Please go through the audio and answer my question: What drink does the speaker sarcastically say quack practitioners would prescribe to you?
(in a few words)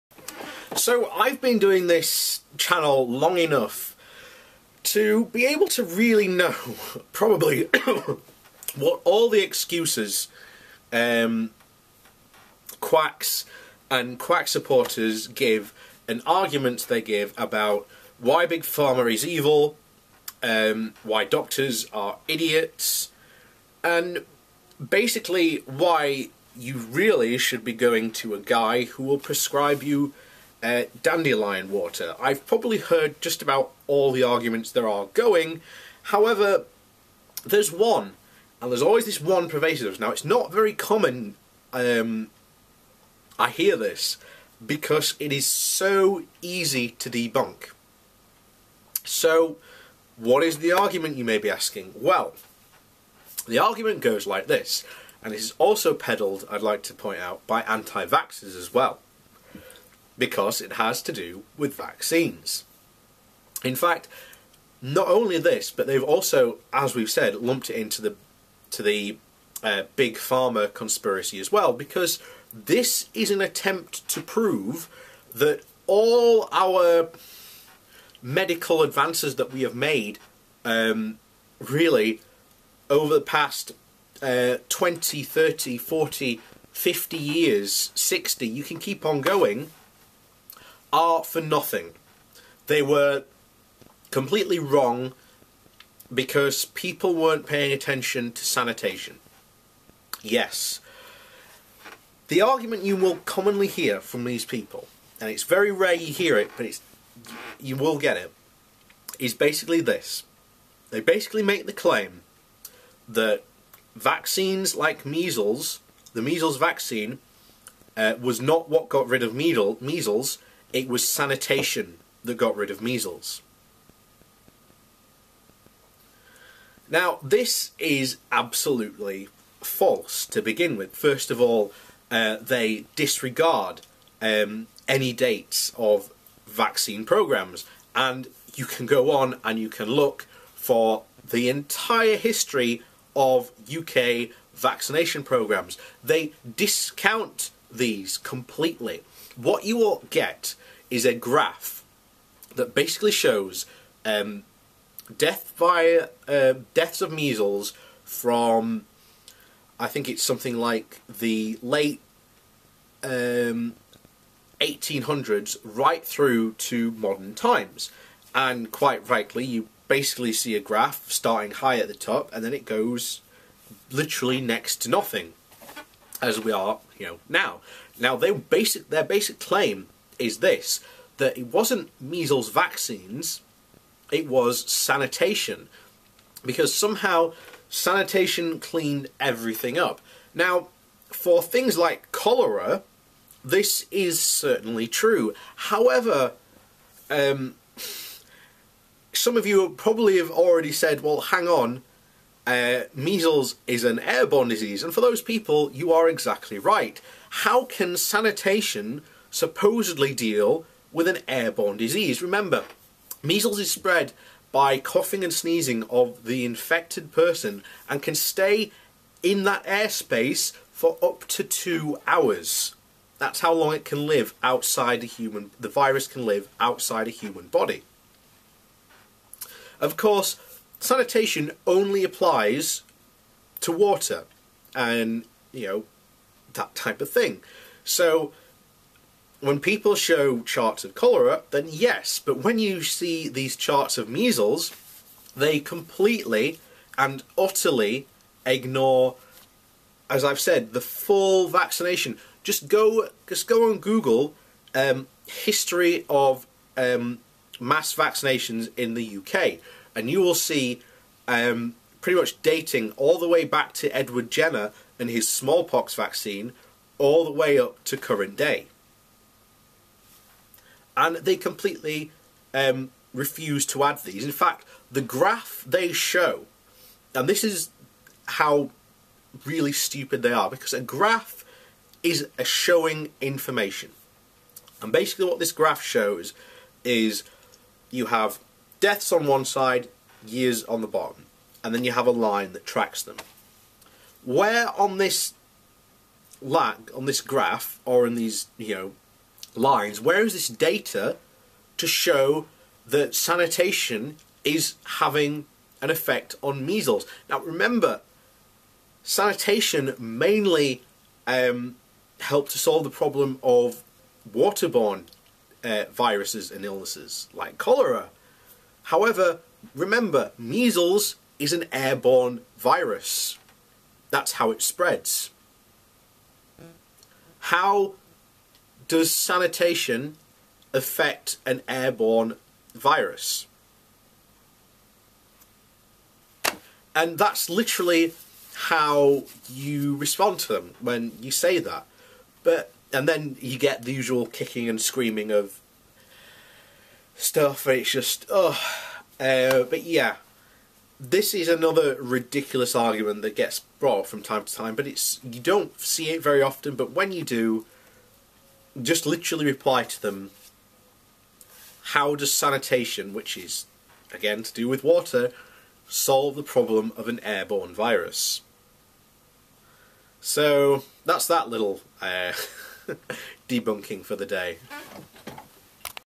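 Dandelion water.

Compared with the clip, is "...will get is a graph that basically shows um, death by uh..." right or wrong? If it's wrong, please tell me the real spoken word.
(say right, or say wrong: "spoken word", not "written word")
right.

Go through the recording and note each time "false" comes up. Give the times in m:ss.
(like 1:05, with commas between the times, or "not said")
2:09.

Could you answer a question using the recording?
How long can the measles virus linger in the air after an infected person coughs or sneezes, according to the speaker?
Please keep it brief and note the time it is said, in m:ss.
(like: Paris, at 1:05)
2 hours, at 3:41.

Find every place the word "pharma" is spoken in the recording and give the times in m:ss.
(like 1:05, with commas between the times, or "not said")
0:18, 1:10.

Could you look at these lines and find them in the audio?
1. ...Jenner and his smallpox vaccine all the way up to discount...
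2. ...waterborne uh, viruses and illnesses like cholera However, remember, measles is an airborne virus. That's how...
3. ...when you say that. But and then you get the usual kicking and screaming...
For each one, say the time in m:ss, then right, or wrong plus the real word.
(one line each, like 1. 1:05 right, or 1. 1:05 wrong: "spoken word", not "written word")
1. 4:24 wrong: "current", not "discount"
2. 5:14 right
3. 5:40 right.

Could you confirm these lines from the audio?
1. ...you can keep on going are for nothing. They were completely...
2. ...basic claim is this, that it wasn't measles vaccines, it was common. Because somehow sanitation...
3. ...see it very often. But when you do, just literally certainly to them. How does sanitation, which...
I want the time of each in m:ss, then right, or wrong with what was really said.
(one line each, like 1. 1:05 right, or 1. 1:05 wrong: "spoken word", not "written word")
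1. 1:28 right
2. 2:59 wrong: "sanitation", not "common"
3. 5:55 wrong: "reply", not "certainly".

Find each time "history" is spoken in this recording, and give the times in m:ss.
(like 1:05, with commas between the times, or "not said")
2:22, 4:15.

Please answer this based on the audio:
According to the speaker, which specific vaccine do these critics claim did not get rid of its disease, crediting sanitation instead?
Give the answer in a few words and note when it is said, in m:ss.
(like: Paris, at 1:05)
Measles vaccine, at 1:56.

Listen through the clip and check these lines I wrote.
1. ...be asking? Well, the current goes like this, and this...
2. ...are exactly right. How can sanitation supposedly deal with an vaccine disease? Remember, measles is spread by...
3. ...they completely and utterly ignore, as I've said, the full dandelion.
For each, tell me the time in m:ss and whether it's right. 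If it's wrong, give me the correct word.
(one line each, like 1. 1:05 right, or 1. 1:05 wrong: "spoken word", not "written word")
1. 0:51 wrong: "argument", not "current"
2. 3:25 wrong: "airborne", not "vaccine"
3. 4:05 wrong: "vaccination", not "dandelion".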